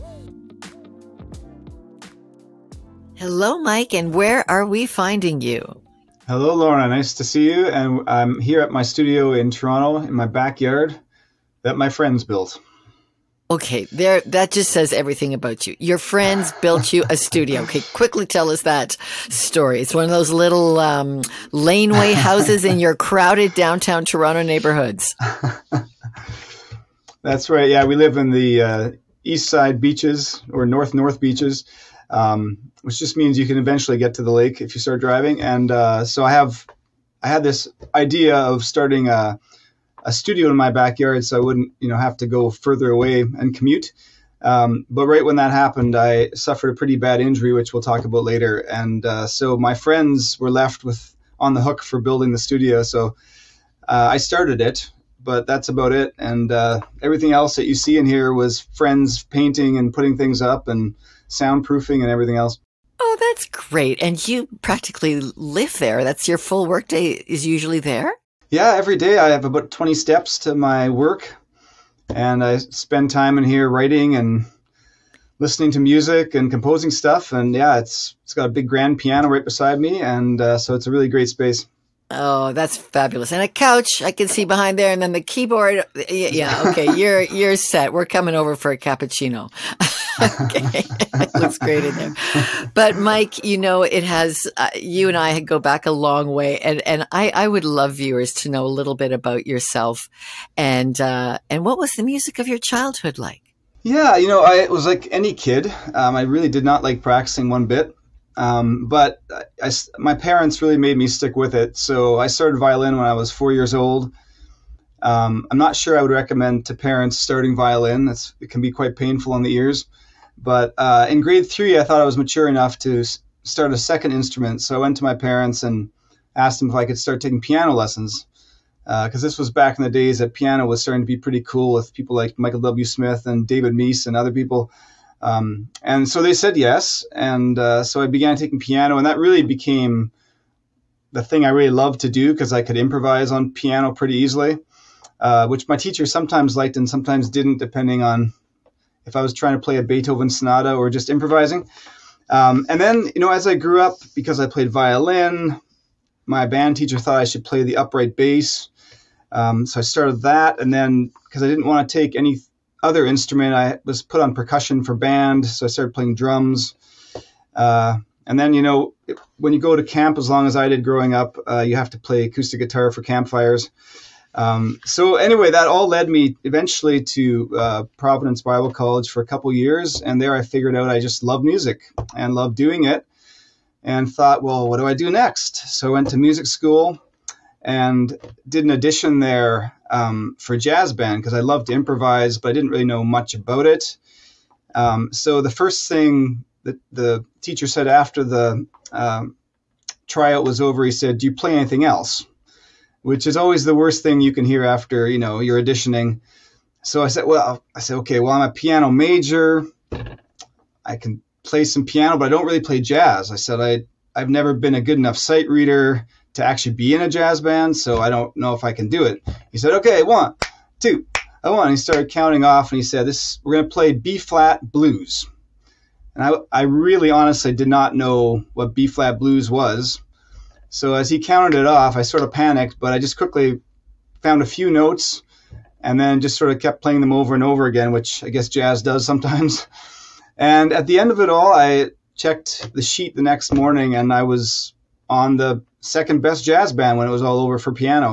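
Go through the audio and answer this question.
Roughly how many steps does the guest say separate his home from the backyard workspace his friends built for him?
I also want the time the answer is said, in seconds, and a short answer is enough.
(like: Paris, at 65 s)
20, at 69 s.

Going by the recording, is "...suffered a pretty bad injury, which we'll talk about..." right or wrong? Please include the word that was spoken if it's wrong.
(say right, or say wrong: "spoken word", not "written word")
right.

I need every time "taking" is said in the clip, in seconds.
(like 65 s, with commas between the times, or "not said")
127 s, 138 s.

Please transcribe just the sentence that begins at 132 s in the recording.
Smith and David Meece and other people.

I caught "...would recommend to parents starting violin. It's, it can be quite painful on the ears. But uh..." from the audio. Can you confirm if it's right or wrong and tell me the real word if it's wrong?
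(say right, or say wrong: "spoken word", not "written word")
right.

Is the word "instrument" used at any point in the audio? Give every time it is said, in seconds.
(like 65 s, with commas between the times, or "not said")
124 s, 163 s.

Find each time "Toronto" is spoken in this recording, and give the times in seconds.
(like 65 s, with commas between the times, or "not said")
9 s, 24 s.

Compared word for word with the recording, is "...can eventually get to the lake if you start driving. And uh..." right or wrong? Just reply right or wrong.
right.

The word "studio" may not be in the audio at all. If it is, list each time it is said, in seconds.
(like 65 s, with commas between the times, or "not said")
8 s, 17 s, 40 s, 52 s.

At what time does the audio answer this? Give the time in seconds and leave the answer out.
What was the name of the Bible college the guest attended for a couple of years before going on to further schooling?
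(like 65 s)
177 s.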